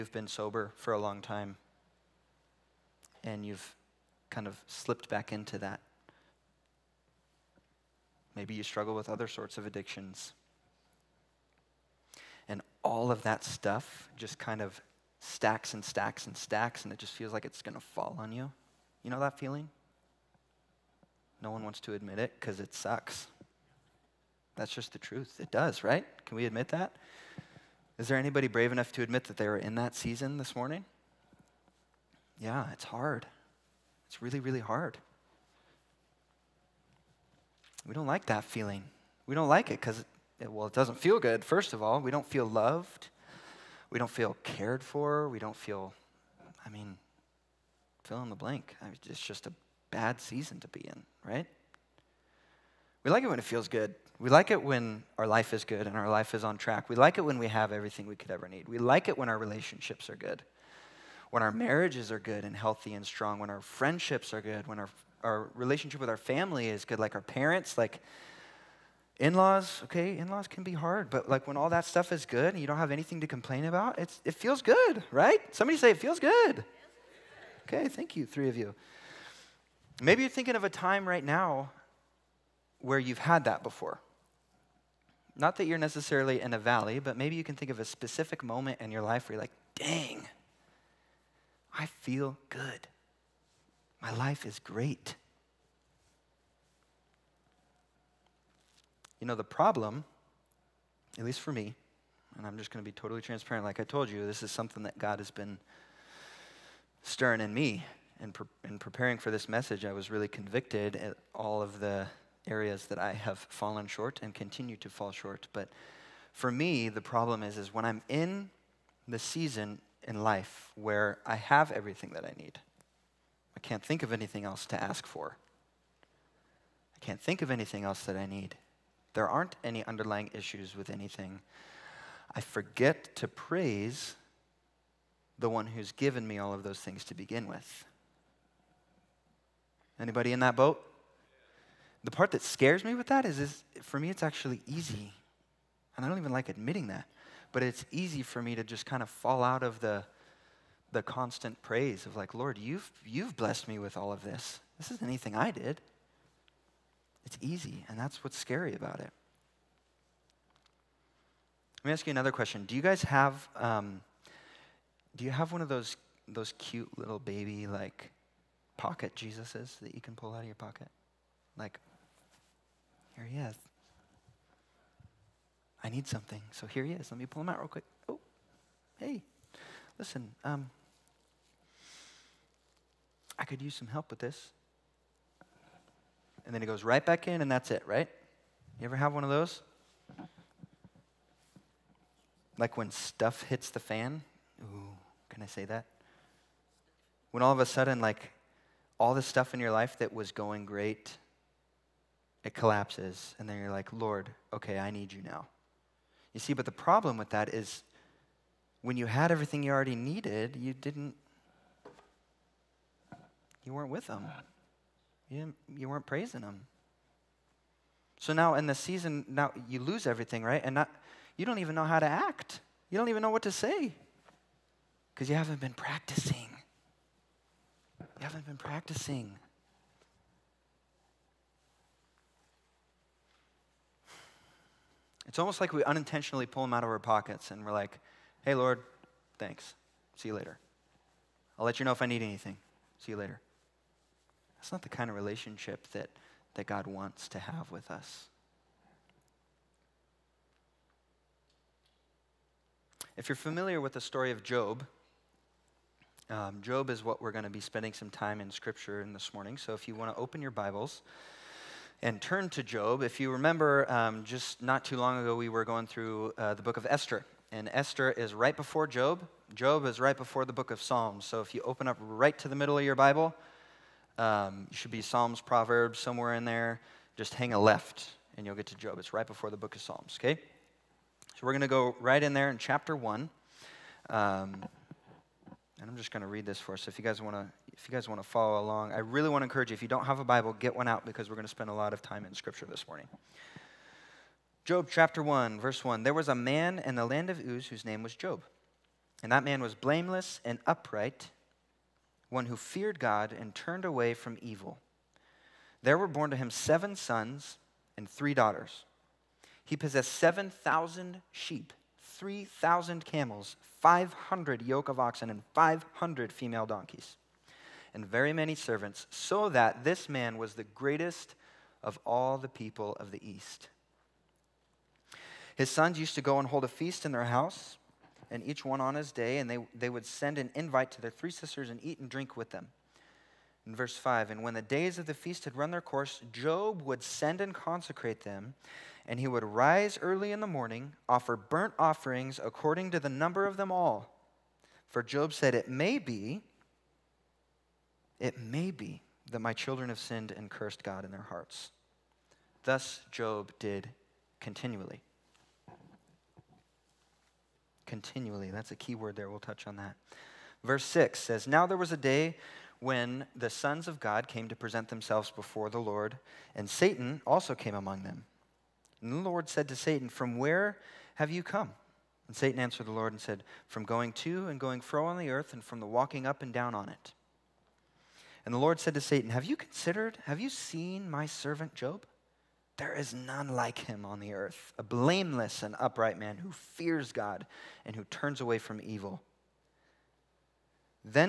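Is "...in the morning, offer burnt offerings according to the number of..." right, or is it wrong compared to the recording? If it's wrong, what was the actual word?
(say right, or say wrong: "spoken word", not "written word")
right.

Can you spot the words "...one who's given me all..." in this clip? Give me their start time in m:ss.
2:15.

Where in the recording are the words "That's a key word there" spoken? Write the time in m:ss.
5:58.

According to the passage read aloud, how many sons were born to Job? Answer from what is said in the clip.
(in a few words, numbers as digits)
7.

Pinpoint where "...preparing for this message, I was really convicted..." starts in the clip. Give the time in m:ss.
1:48.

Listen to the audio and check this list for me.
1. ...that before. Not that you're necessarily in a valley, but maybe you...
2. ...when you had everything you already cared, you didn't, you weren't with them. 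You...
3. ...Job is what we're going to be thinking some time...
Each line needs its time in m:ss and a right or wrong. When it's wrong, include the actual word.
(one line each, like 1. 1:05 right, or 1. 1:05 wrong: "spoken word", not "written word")
1. 1:23 right
2. 3:28 wrong: "needed", not "cared"
3. 4:16 wrong: "spending", not "thinking".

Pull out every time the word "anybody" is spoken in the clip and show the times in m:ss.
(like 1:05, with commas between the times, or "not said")
0:28, 2:19.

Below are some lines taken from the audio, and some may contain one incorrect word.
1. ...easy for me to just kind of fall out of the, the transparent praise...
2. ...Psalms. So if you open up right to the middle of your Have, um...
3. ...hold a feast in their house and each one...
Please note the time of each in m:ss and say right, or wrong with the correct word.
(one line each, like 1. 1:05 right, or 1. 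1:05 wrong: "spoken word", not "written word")
1. 2:27 wrong: "constant", not "transparent"
2. 4:30 wrong: "Bible", not "Have"
3. 5:26 right.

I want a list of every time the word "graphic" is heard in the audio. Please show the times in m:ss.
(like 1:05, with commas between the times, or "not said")
not said.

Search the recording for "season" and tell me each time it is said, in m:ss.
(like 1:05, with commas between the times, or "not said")
0:29, 0:50, 1:59, 3:38.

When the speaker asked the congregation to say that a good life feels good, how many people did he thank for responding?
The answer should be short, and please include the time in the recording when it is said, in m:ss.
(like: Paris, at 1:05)
3, at 1:18.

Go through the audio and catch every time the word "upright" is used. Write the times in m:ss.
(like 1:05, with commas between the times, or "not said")
5:00, 6:25.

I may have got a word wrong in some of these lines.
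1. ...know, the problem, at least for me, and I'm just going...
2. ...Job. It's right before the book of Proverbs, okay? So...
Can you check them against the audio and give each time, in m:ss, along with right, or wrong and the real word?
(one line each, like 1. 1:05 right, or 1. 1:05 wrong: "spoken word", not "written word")
1. 1:39 right
2. 4:38 wrong: "Psalms", not "Proverbs".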